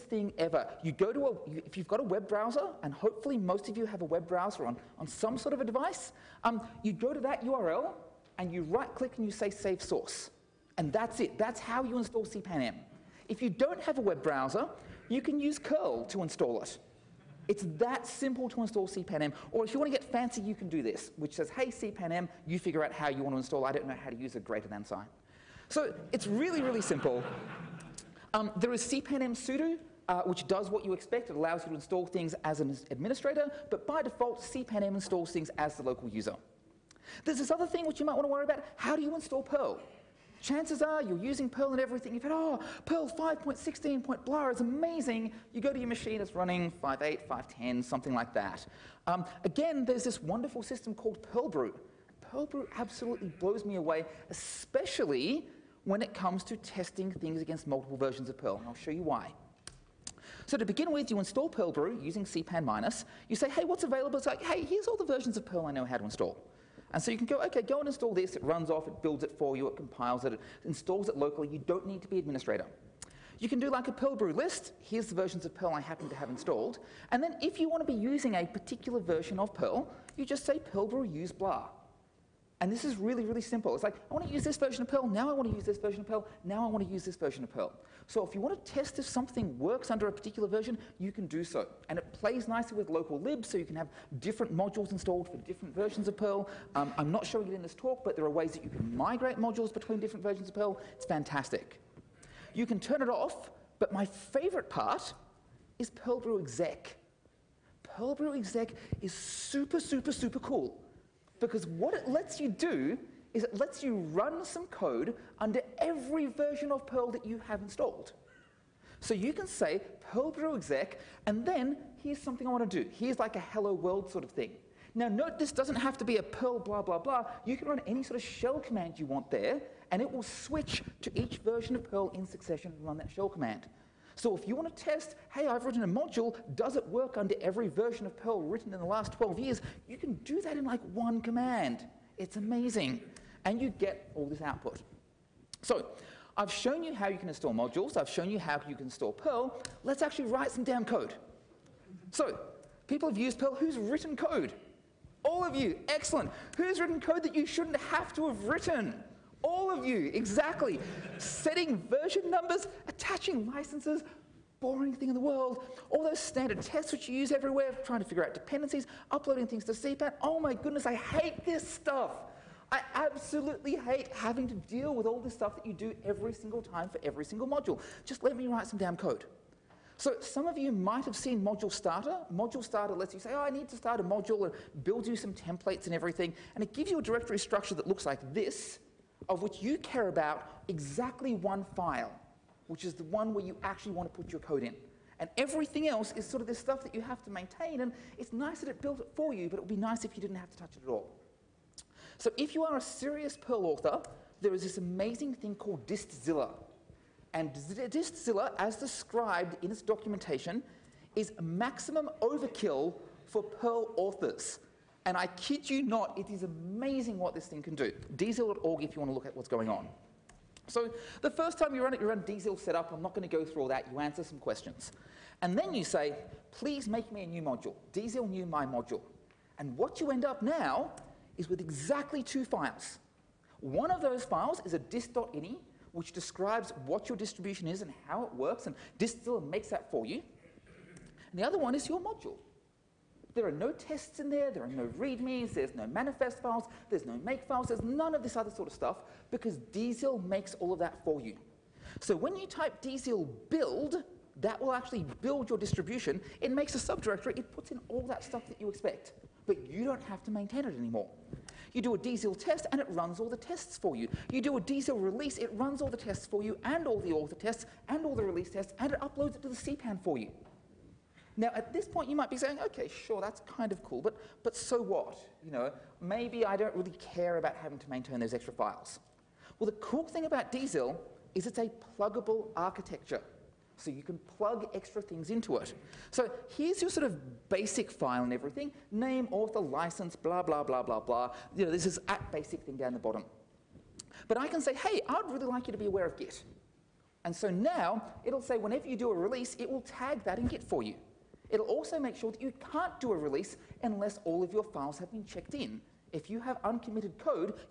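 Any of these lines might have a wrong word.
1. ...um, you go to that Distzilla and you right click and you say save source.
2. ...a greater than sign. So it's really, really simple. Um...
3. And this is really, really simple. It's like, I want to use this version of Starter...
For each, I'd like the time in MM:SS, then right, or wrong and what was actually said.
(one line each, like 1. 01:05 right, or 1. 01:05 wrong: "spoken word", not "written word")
1. 00:06 wrong: "URL", not "Distzilla"
2. 00:24 right
3. 01:22 wrong: "Perl", not "Starter".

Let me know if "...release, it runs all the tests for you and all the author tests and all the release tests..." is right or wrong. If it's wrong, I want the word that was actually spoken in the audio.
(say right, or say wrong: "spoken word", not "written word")
right.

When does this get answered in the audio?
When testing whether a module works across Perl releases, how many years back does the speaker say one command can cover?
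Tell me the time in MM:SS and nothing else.
02:19.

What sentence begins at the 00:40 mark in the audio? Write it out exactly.
Chances are you're using Perl and everything.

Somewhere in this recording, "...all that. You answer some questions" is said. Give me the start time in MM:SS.
03:43.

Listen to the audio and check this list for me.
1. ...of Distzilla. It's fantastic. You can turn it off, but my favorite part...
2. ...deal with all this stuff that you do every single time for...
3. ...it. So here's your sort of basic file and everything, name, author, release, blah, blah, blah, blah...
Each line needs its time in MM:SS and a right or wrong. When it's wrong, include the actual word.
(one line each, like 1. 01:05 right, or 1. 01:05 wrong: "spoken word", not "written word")
1. 01:40 wrong: "Perl", not "Distzilla"
2. 02:54 right
3. 04:45 wrong: "license", not "release".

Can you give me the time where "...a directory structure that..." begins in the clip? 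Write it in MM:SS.
03:06.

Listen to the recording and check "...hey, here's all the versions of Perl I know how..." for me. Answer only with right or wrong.
right.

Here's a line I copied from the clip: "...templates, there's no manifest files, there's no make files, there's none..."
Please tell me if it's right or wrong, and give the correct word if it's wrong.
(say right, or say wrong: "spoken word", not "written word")
wrong: "readmes", not "templates".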